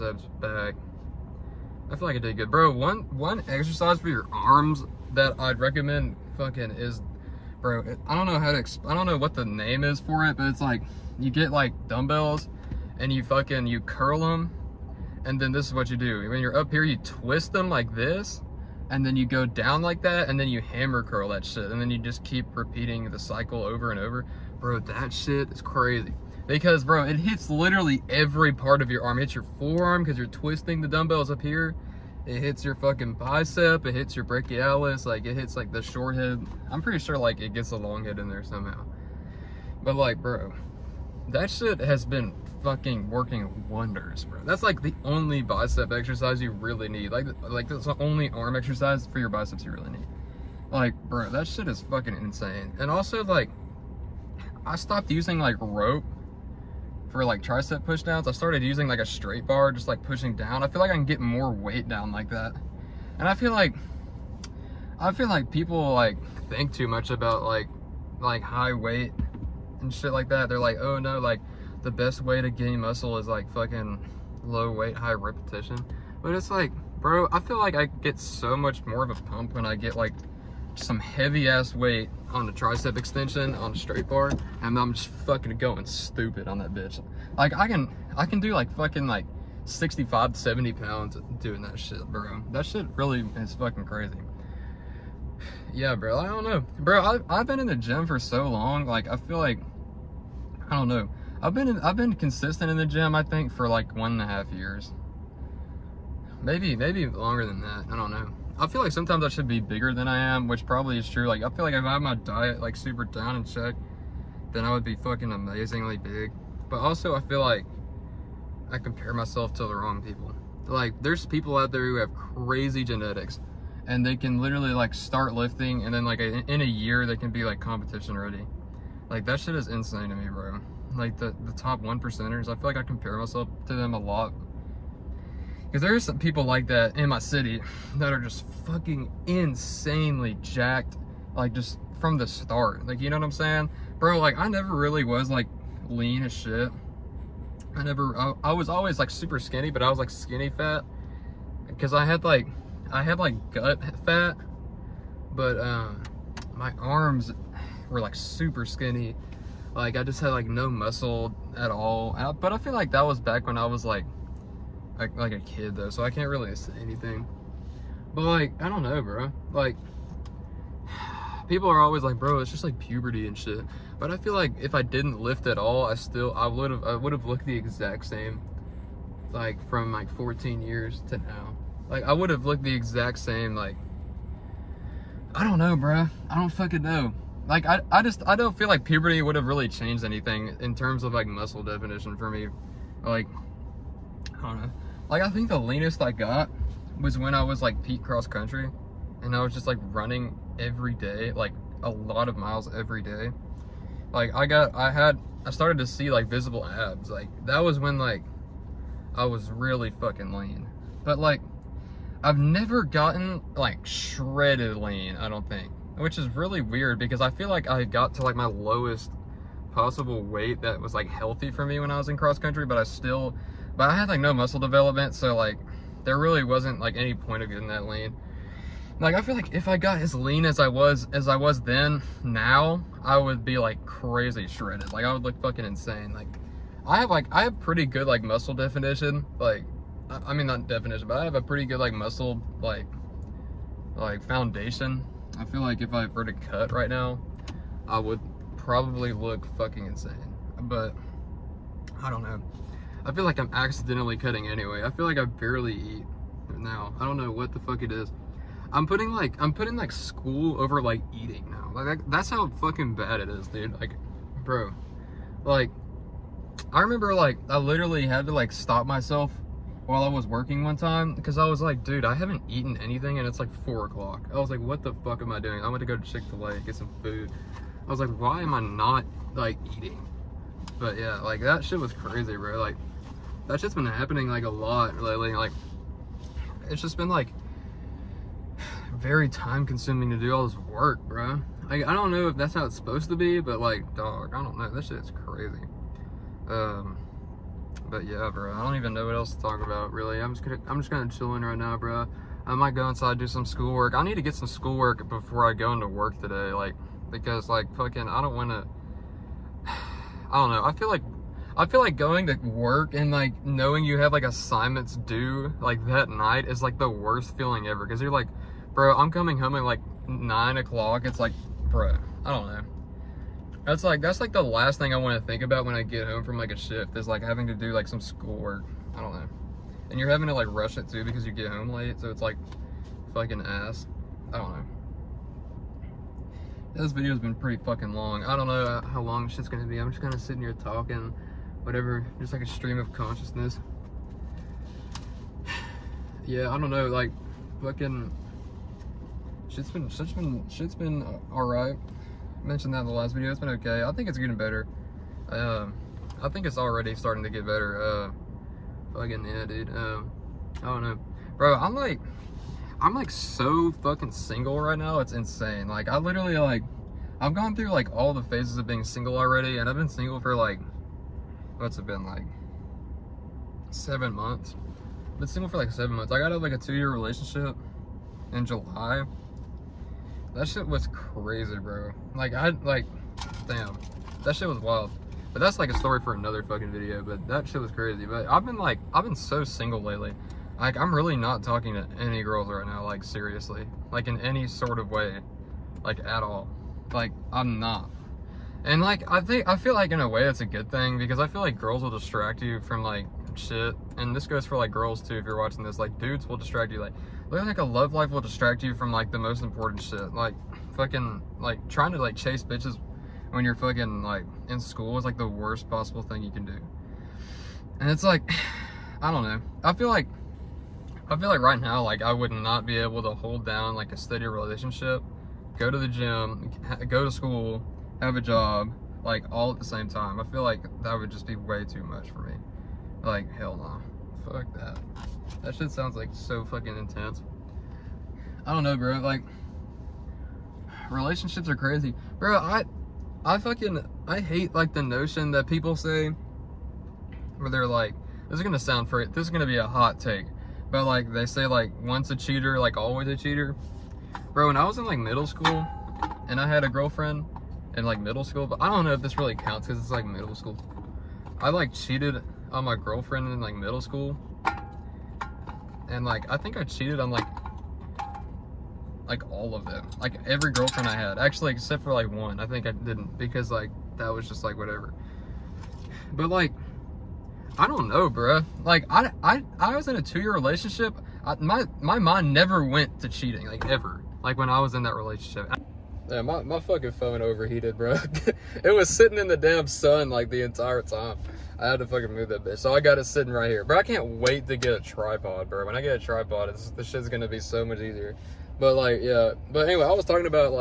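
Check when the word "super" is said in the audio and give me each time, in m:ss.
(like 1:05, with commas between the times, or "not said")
1:52, 2:29, 2:38.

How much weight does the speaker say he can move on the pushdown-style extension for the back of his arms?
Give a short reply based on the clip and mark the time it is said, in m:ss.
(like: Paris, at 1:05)
65 to 70 pounds, at 1:29.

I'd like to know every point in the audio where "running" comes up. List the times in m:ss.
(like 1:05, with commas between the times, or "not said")
3:19.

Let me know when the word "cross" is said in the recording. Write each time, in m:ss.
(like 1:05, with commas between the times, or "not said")
3:18, 3:42.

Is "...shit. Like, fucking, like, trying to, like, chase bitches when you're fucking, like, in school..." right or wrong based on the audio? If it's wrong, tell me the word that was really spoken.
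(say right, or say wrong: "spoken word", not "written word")
right.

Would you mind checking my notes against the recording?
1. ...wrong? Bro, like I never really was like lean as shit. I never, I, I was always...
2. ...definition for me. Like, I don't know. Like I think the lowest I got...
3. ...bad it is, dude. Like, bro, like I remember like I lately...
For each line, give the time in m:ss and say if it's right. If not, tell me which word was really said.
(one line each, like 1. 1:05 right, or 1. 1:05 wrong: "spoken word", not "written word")
1. 2:23 wrong: "saying", not "wrong"
2. 3:11 wrong: "leanest", not "lowest"
3. 4:22 wrong: "literally", not "lately".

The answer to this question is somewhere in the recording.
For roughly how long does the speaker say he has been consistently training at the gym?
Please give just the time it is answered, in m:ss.
1:43.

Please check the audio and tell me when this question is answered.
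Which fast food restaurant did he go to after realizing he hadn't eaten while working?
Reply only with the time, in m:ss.
4:36.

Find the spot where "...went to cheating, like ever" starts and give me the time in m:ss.
8:02.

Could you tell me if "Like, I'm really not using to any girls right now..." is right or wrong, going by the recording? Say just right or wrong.
wrong.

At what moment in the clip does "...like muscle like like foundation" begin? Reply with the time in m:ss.
4:01.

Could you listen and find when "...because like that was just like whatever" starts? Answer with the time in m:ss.
7:53.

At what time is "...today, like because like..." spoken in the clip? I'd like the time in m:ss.
5:06.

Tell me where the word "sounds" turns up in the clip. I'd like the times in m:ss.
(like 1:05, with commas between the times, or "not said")
7:15, 7:28.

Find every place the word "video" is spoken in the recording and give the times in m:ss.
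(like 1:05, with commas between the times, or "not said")
5:36, 5:53, 6:26.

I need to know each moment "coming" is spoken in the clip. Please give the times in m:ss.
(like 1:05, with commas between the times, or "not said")
5:19.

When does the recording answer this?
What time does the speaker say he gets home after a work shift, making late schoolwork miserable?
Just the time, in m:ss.
5:20.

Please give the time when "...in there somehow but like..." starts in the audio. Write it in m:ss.
0:38.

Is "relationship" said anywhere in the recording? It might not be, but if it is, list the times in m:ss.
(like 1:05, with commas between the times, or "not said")
6:16, 7:04, 7:20, 8:00, 8:04.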